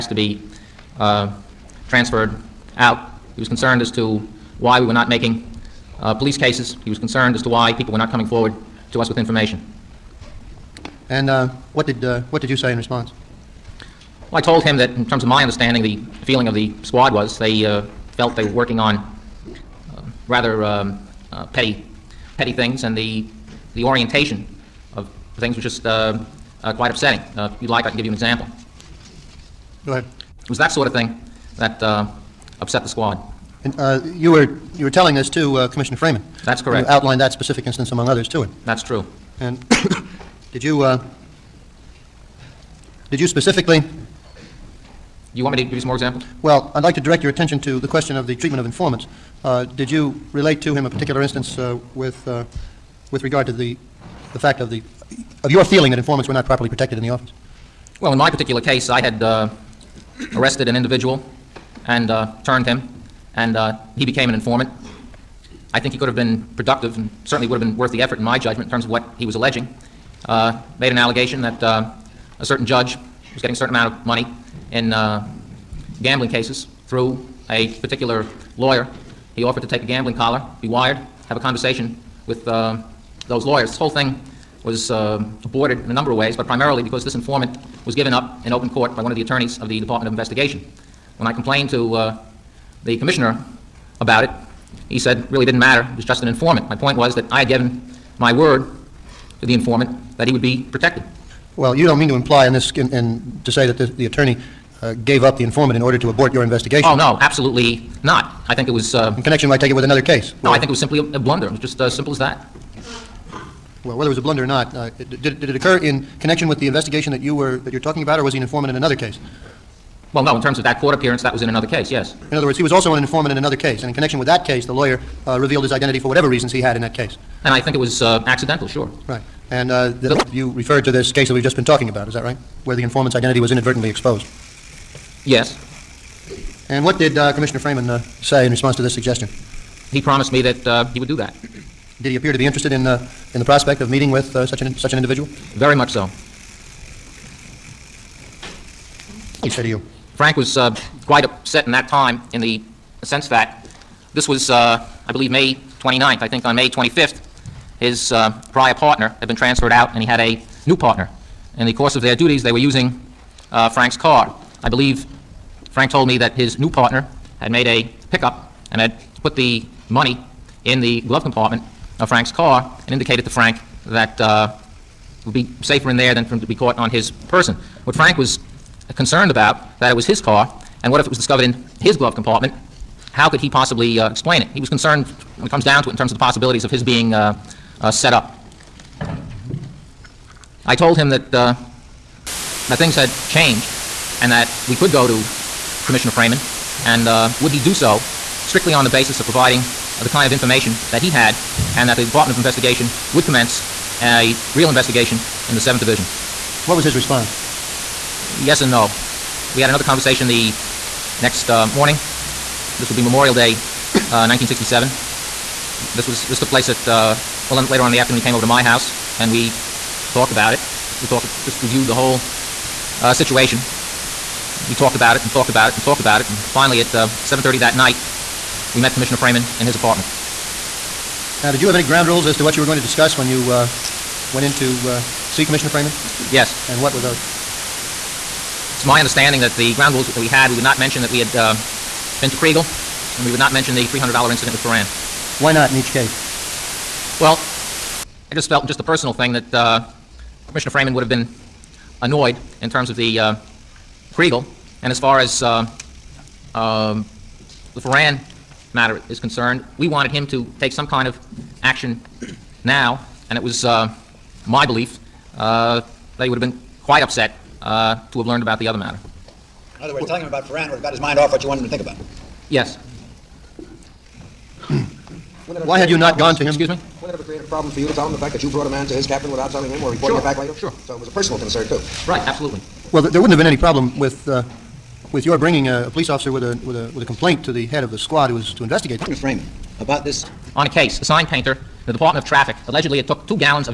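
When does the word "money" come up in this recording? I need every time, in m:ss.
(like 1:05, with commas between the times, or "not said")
1:14, 2:49.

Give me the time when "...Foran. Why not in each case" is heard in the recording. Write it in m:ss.
4:04.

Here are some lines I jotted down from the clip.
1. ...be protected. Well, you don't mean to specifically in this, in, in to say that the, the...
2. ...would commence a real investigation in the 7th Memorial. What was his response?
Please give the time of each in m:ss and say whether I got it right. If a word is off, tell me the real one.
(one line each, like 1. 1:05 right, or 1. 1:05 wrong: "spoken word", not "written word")
1. 1:40 wrong: "imply", not "specifically"
2. 3:23 wrong: "Division", not "Memorial".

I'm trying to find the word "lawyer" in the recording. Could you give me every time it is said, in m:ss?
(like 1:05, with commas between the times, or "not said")
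1:18, 1:23, 2:04.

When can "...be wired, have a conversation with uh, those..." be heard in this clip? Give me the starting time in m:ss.
1:20.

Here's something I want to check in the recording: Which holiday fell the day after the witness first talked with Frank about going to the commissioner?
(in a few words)
Memorial Day.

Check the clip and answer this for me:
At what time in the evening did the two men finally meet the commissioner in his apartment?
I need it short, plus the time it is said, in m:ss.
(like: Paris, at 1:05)
7:30, at 3:47.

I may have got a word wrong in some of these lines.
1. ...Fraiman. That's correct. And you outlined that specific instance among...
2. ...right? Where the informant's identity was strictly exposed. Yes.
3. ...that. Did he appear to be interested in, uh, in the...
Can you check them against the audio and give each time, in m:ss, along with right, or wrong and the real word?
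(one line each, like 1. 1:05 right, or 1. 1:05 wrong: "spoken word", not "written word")
1. 0:35 right
2. 2:12 wrong: "inadvertently", not "strictly"
3. 2:21 right.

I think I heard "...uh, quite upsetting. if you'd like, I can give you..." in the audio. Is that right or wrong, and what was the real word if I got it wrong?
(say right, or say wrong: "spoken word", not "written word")
right.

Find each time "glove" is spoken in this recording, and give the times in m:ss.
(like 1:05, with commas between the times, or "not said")
2:51, 3:01.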